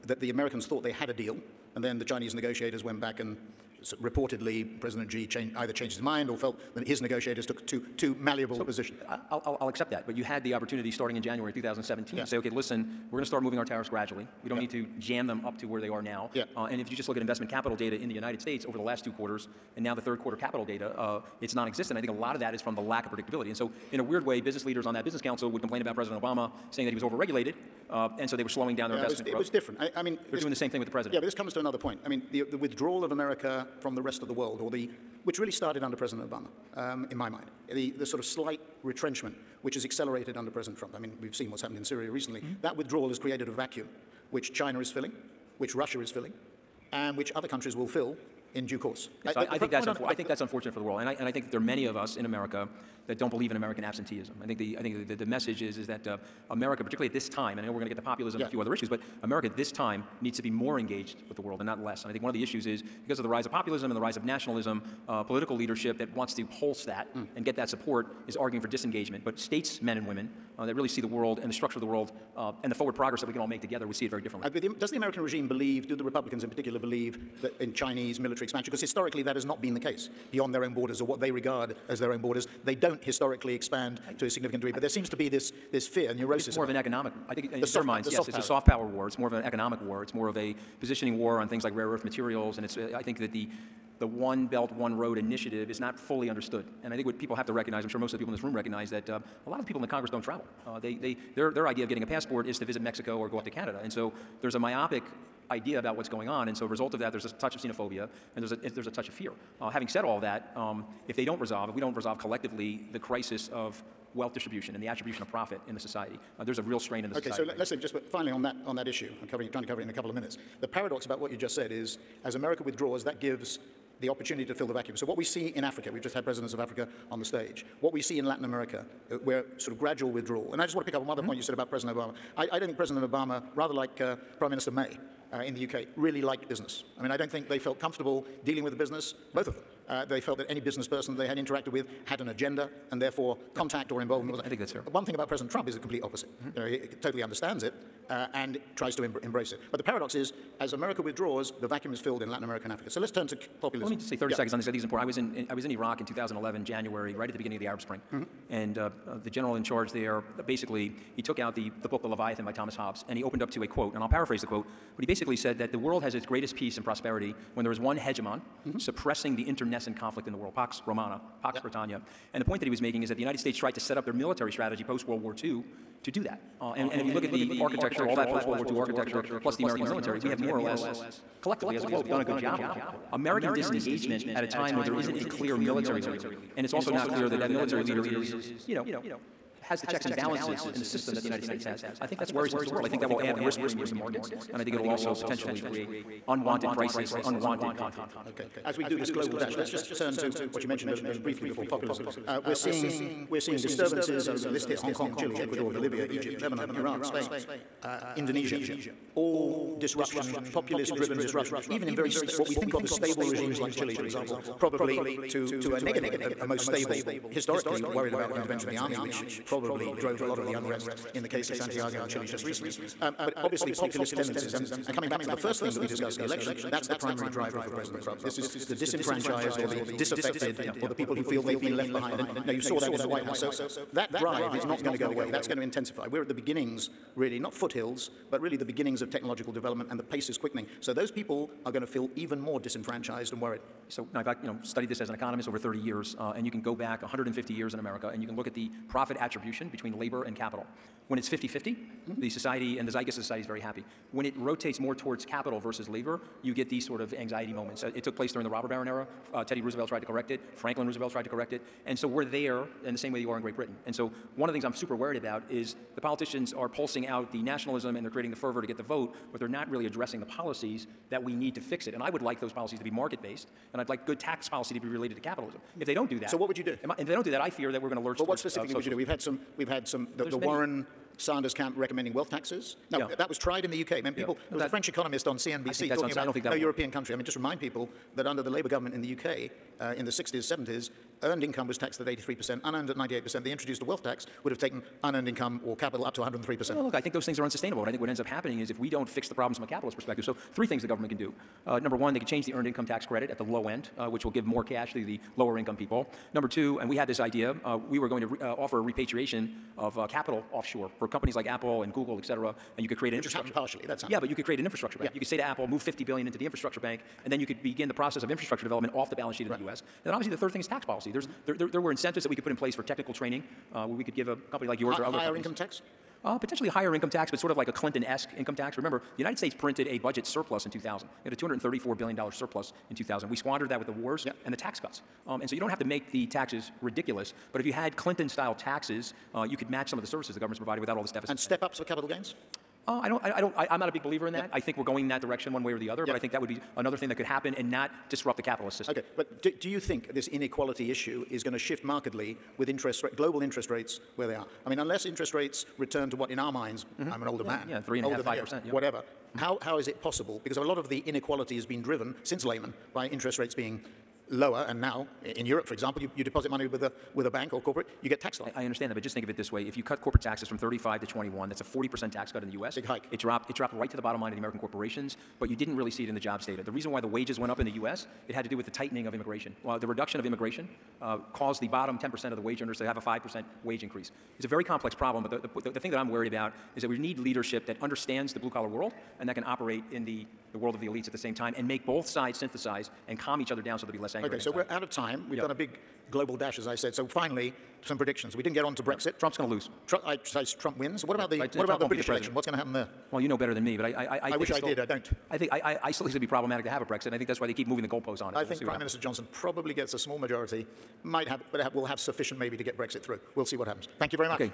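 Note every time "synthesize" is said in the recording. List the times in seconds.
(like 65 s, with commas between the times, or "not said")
392 s.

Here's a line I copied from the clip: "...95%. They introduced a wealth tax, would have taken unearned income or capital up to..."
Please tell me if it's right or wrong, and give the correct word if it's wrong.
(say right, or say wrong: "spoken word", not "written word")
wrong: "98", not "95".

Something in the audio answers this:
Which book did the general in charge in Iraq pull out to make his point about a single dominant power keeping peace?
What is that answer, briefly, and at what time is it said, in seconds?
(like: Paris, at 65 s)
The Leviathan, at 162 s.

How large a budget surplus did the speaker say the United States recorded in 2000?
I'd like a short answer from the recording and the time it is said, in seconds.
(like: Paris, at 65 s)
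$234 billion, at 331 s.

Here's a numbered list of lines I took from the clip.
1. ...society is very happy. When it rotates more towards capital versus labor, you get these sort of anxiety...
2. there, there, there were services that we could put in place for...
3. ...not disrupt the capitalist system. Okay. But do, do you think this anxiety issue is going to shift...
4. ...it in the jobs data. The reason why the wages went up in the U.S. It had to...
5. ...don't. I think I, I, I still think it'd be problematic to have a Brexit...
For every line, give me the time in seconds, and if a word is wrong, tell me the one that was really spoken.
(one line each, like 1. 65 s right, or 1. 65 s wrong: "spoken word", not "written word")
1. 253 s right
2. 321 s wrong: "incentives", not "services"
3. 347 s wrong: "inequality", not "anxiety"
4. 376 s right
5. 404 s right.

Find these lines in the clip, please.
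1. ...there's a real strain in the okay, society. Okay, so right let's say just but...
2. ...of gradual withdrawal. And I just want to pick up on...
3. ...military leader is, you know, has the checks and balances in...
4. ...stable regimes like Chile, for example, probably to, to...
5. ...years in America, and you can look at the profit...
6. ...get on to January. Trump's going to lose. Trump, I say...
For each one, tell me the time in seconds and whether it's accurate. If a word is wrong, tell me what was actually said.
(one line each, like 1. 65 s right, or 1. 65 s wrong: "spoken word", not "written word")
1. 116 s right
2. 129 s right
3. 187 s right
4. 212 s right
5. 247 s right
6. 398 s wrong: "Brexit", not "January".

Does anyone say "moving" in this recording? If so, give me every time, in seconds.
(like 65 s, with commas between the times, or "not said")
13 s, 407 s.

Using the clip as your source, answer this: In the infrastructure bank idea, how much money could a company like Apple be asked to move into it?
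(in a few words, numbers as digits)
50 billion.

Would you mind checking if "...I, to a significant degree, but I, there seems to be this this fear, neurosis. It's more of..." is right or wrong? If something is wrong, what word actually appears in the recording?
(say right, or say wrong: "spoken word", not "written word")
right.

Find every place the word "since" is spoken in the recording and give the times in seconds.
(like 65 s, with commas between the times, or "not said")
362 s.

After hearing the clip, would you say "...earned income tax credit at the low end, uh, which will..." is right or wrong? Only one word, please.
right.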